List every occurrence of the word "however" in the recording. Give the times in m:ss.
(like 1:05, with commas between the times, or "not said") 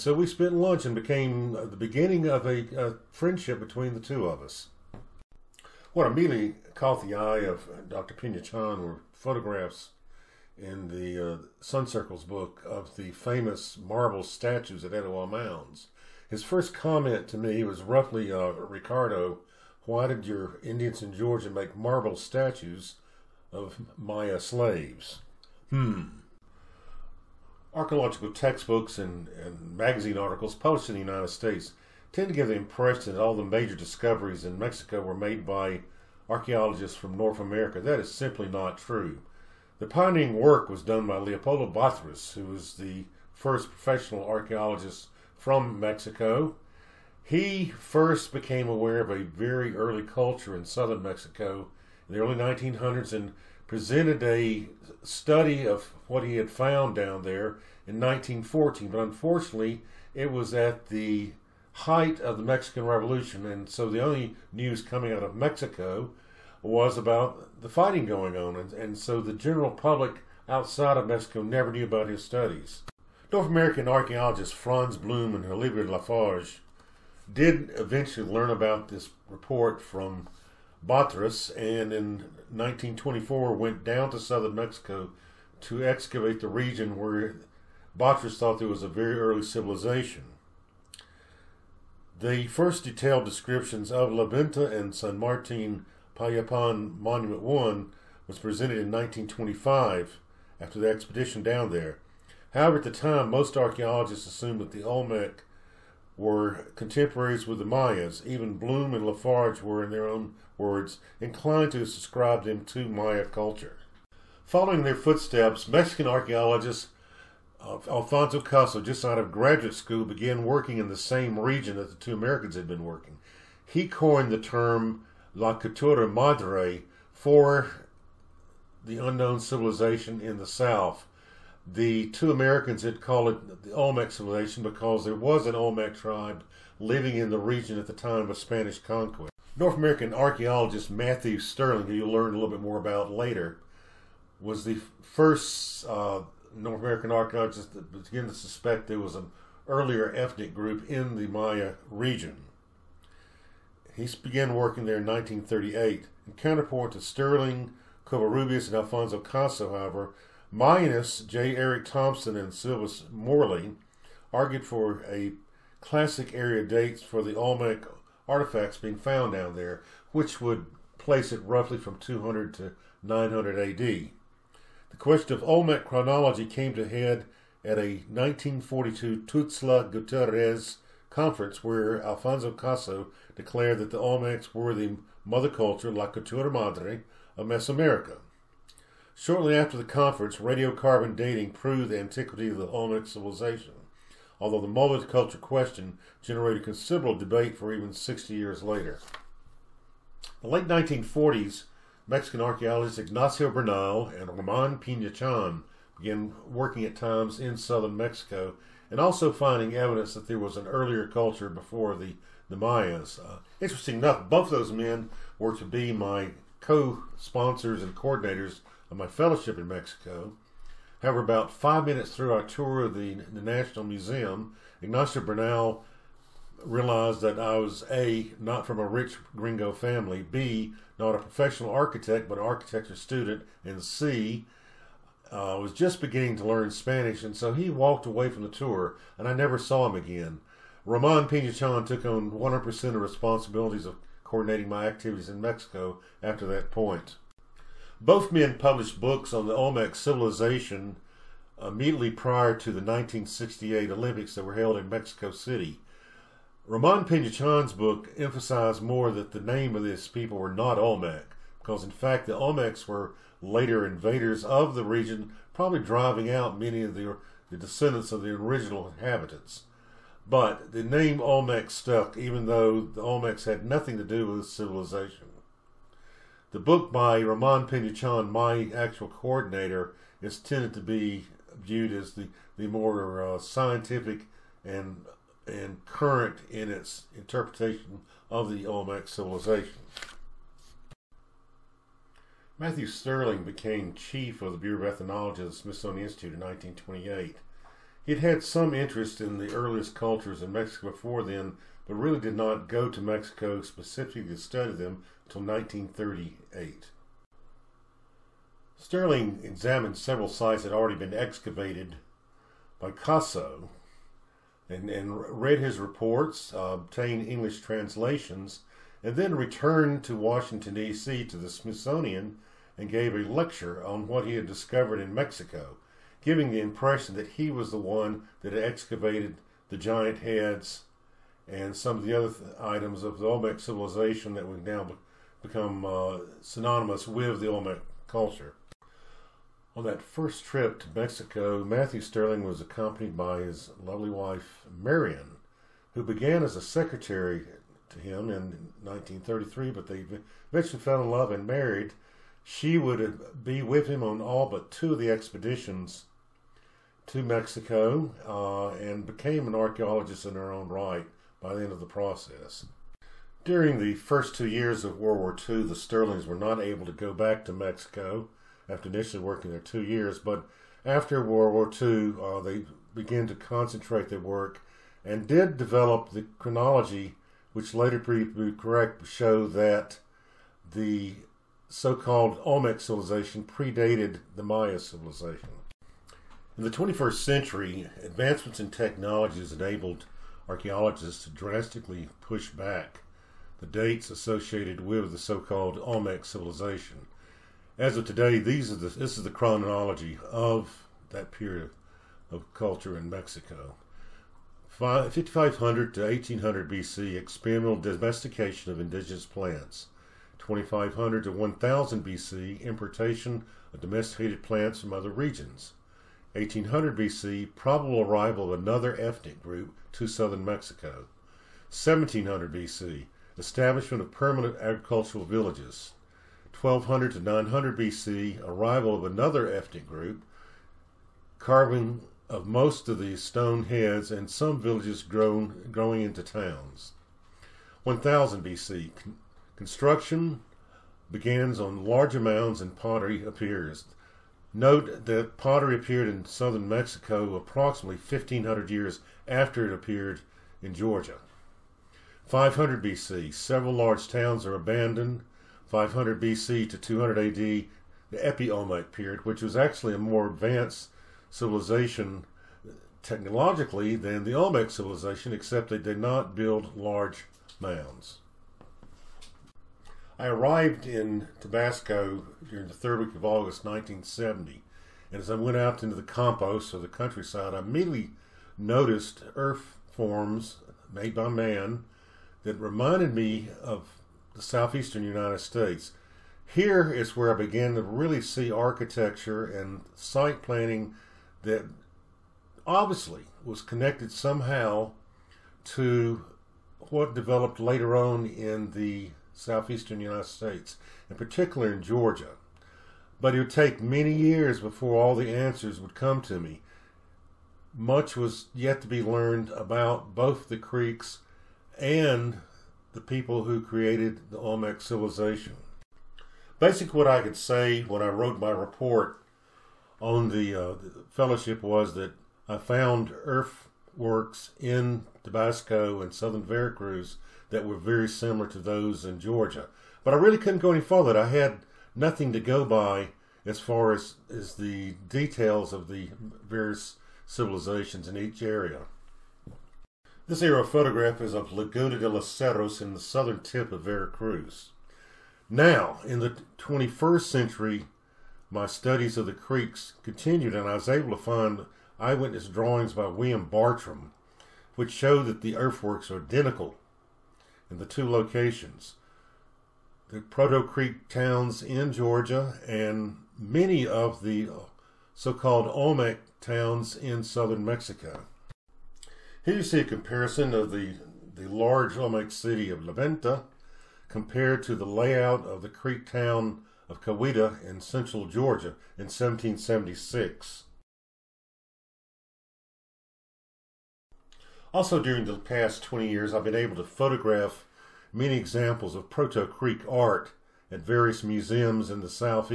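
1:42, 2:39, 3:41.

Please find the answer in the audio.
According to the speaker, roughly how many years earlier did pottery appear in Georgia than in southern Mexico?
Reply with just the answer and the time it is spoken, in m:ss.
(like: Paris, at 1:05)
1500 years, at 7:27.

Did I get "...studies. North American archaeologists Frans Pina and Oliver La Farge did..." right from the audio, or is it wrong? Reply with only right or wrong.
wrong.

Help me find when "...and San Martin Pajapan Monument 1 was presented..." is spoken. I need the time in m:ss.
1:34.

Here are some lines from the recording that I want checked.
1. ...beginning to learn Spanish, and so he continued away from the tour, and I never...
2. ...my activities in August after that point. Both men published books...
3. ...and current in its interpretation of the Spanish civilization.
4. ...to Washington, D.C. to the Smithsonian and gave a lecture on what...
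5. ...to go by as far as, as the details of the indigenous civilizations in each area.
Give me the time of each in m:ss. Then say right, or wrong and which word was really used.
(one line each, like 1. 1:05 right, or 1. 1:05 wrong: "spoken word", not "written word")
1. 3:56 wrong: "walked", not "continued"
2. 4:04 wrong: "Mexico", not "August"
3. 4:45 wrong: "Olmec", not "Spanish"
4. 5:20 right
5. 8:52 wrong: "various", not "indigenous".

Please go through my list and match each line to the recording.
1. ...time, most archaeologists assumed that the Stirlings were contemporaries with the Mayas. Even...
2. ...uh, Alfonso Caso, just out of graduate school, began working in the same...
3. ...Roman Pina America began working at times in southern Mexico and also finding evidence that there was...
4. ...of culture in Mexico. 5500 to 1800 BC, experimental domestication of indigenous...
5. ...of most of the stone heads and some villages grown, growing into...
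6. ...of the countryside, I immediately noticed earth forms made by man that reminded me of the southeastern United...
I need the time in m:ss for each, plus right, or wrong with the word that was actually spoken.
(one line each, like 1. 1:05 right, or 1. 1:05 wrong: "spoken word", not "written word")
1. 1:42 wrong: "Olmec", not "Stirlings"
2. 1:57 right
3. 3:24 wrong: "Chan", not "America"
4. 6:42 right
5. 7:12 right
6. 7:56 right.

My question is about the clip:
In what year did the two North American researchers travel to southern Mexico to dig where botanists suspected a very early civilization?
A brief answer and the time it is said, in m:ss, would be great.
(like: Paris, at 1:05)
1924, at 1:22.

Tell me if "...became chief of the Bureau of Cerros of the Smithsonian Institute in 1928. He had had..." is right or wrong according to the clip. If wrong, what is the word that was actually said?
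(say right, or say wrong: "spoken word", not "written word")
wrong: "Ethnology", not "Cerros".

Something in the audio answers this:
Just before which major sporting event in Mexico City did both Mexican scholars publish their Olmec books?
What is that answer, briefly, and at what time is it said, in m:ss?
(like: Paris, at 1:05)
1968 Olympics, at 4:12.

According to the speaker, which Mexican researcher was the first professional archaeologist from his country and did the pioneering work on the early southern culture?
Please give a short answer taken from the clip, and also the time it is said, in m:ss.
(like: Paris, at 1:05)
Leopoldo Batres, at 0:41.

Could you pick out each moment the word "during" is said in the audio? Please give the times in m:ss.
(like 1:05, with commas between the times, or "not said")
6:03, 7:52, 9:45.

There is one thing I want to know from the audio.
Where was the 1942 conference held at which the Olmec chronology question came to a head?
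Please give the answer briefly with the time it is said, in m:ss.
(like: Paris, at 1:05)
Tuxtla Gutierrez, at 2:59.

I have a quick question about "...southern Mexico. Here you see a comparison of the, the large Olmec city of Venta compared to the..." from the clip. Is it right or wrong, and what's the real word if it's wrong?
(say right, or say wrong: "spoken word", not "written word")
right.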